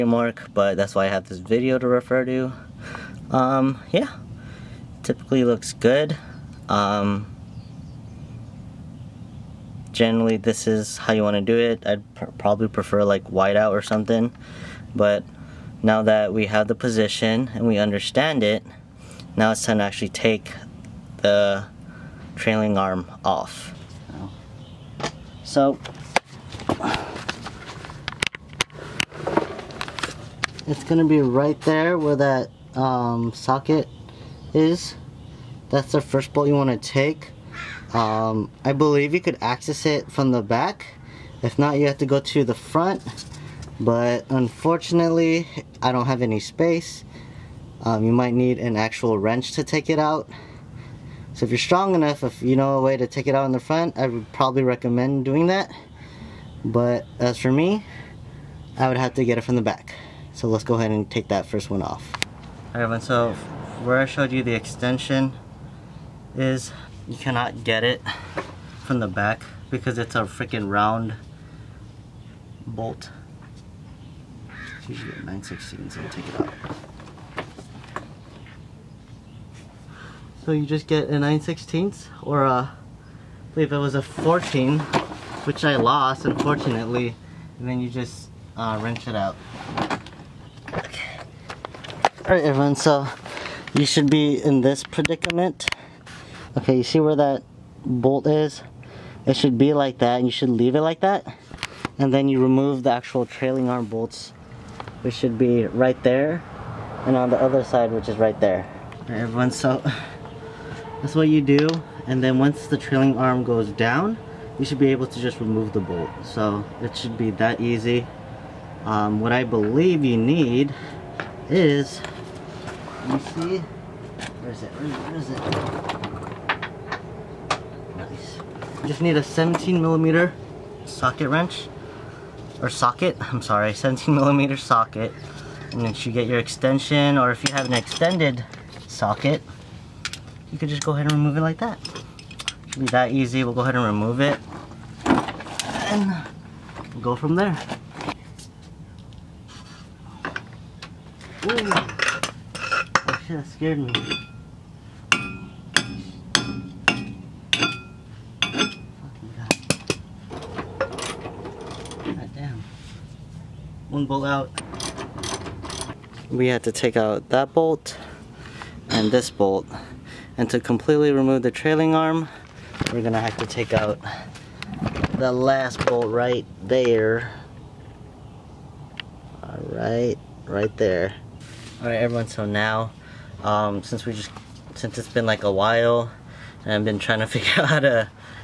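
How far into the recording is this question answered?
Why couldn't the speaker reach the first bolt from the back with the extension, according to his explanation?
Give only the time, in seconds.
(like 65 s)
70 s.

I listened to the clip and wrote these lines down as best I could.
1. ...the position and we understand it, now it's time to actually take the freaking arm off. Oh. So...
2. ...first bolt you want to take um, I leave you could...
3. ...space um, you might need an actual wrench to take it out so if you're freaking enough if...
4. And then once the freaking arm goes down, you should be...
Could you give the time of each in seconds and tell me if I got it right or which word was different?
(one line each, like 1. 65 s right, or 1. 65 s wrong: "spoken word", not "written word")
1. 16 s wrong: "trailing", not "freaking"
2. 36 s wrong: "believe", not "leave"
3. 46 s wrong: "strong", not "freaking"
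4. 112 s wrong: "trailing", not "freaking".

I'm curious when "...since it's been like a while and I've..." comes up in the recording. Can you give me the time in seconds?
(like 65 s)
184 s.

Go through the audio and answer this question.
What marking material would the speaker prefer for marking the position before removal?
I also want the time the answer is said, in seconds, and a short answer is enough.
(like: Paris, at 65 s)
whiteout, at 13 s.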